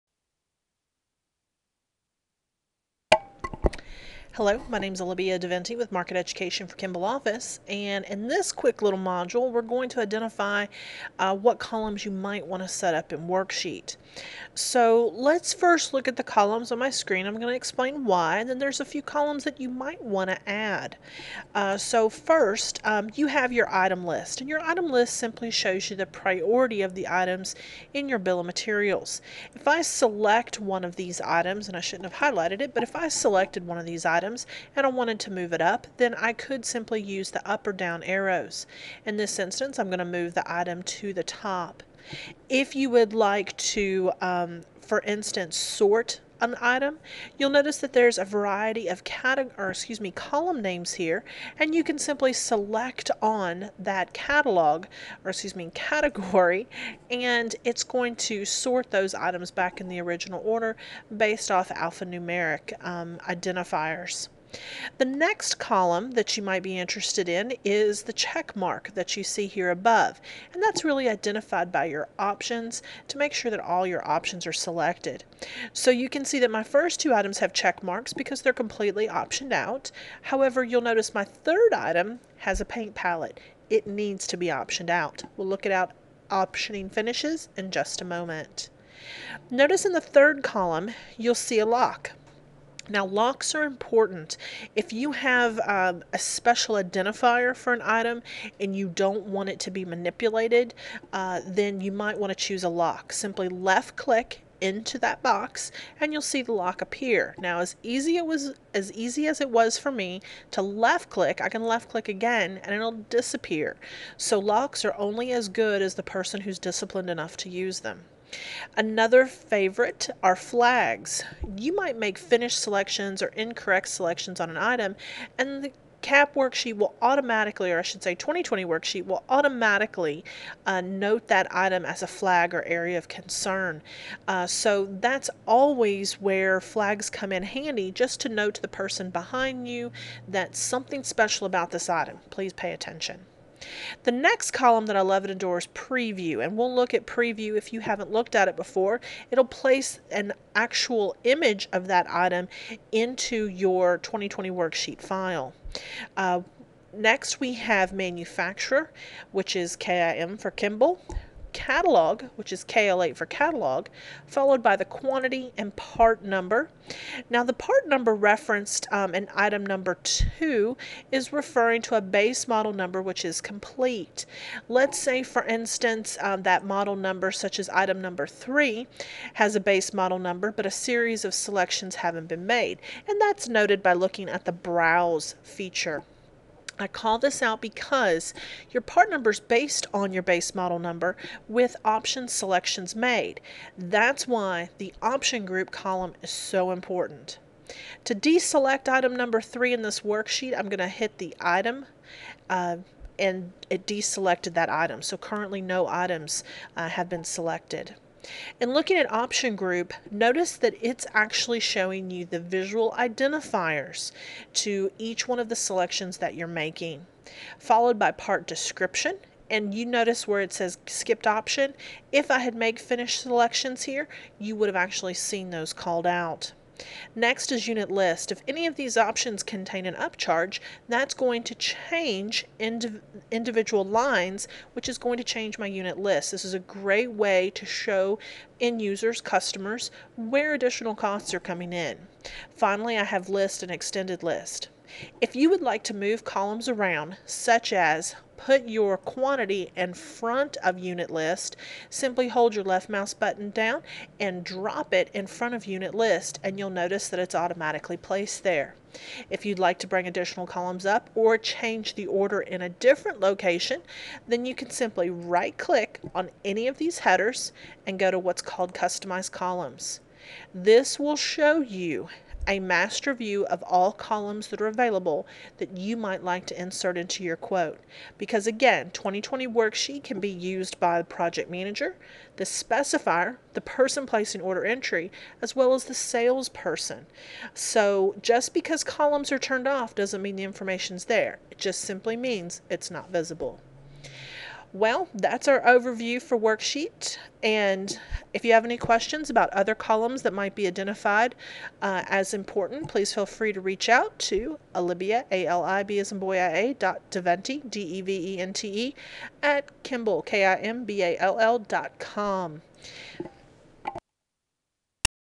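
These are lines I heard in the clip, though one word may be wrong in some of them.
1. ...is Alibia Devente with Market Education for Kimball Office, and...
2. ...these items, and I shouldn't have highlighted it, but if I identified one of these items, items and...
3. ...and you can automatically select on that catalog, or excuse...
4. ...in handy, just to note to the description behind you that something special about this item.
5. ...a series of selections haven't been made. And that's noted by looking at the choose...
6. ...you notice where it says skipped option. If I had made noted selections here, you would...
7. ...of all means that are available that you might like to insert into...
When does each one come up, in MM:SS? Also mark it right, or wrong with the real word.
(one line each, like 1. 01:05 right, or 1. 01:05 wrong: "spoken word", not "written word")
1. 00:04 right
2. 00:30 wrong: "selected", not "identified"
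3. 00:51 wrong: "simply", not "automatically"
4. 02:17 wrong: "person", not "description"
5. 03:00 wrong: "browse", not "choose"
6. 03:39 wrong: "finished", not "noted"
7. 04:33 wrong: "columns", not "means".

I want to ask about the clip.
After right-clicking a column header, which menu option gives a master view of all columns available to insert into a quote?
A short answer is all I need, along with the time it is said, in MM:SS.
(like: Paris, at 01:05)
Customize Columns, at 04:28.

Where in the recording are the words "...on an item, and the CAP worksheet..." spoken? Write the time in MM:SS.
02:04.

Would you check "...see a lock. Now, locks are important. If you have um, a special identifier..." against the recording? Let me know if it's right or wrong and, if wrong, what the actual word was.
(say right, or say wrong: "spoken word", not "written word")
right.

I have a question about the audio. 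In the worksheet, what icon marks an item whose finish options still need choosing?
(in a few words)
Paint palette.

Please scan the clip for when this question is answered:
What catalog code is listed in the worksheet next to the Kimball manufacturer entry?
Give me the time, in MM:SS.
02:42.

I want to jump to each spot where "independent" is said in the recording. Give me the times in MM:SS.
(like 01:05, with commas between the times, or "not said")
not said.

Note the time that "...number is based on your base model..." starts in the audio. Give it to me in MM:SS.
03:09.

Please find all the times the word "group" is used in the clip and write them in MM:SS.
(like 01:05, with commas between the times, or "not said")
03:15, 03:29.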